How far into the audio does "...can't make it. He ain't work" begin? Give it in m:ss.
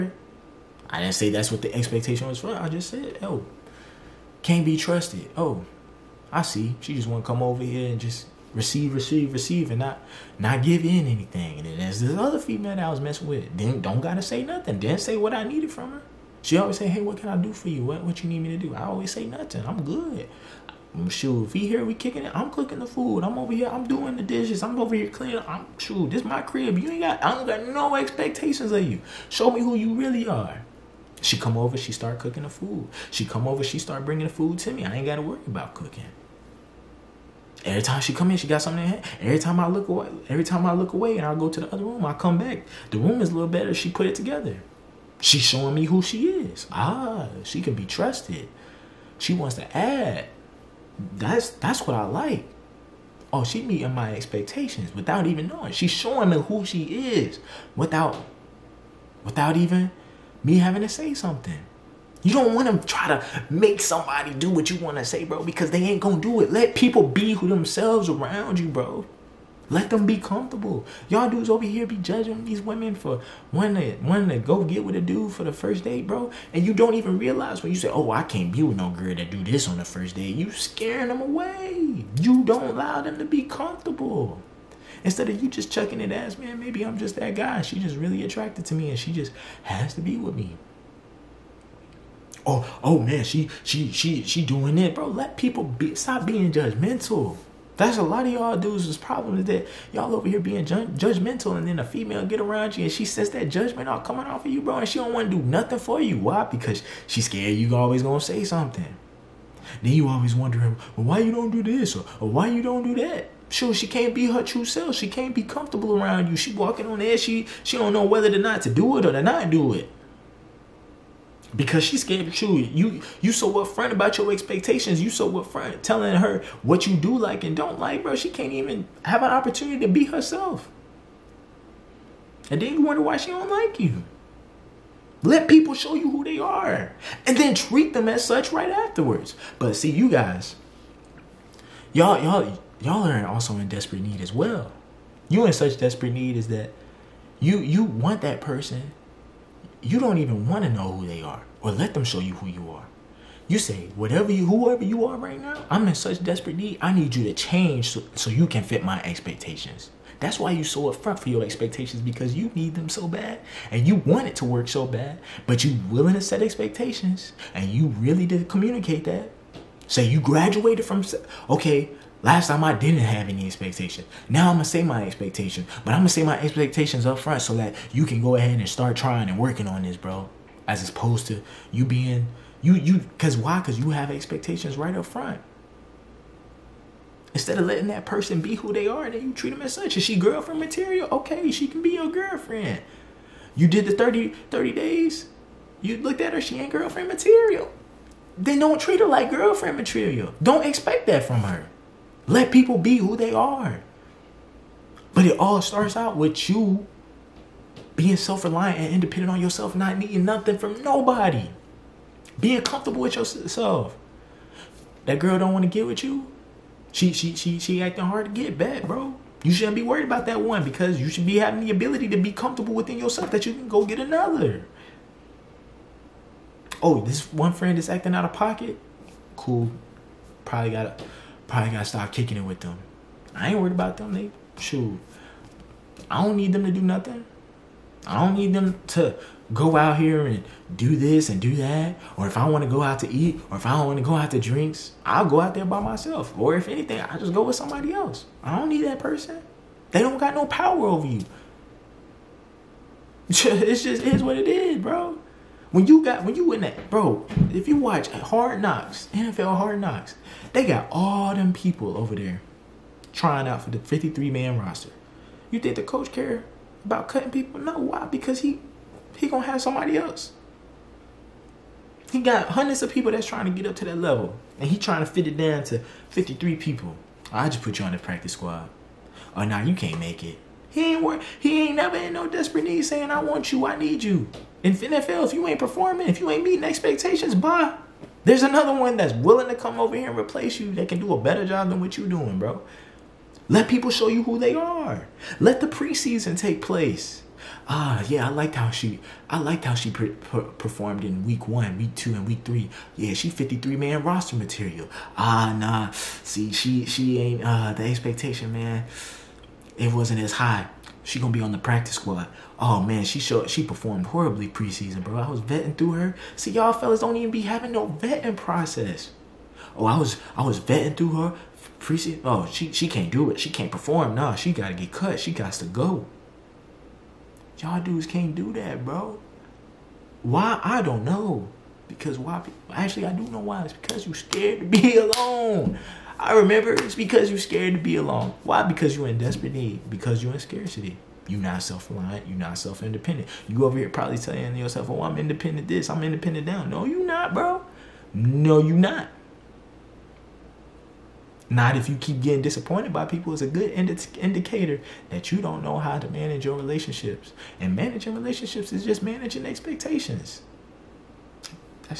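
4:39.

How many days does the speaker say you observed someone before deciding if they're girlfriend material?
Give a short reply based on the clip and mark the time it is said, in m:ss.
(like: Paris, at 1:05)
30, at 3:14.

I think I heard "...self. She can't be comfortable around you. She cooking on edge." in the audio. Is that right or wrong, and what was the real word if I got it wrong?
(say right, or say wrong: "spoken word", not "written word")
wrong: "walking", not "cooking".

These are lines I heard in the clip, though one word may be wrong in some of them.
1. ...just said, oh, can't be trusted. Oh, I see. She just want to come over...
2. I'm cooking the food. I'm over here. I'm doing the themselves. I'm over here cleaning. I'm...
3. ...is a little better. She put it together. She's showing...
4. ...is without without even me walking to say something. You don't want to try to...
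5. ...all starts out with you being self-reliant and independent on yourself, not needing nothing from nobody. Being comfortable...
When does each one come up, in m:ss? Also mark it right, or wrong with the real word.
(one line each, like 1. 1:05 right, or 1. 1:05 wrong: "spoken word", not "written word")
1. 0:02 right
2. 0:22 wrong: "dishes", not "themselves"
3. 0:43 right
4. 0:57 wrong: "having", not "walking"
5. 3:25 right.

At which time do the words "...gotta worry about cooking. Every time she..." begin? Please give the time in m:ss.
0:35.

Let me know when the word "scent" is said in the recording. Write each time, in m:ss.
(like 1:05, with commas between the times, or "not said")
not said.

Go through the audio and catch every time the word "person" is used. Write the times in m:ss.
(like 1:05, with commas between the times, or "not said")
2:28, 3:08, 4:08.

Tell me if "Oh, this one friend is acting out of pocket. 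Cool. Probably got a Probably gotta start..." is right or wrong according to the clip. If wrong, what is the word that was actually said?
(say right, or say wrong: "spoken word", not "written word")
right.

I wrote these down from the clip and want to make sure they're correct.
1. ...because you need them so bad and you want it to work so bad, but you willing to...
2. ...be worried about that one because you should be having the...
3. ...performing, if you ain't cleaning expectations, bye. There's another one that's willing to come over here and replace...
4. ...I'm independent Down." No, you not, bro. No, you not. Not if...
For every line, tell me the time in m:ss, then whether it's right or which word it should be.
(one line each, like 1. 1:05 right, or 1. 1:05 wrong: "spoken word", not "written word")
1. 2:41 right
2. 3:39 right
3. 4:45 wrong: "meeting", not "cleaning"
4. 5:45 right.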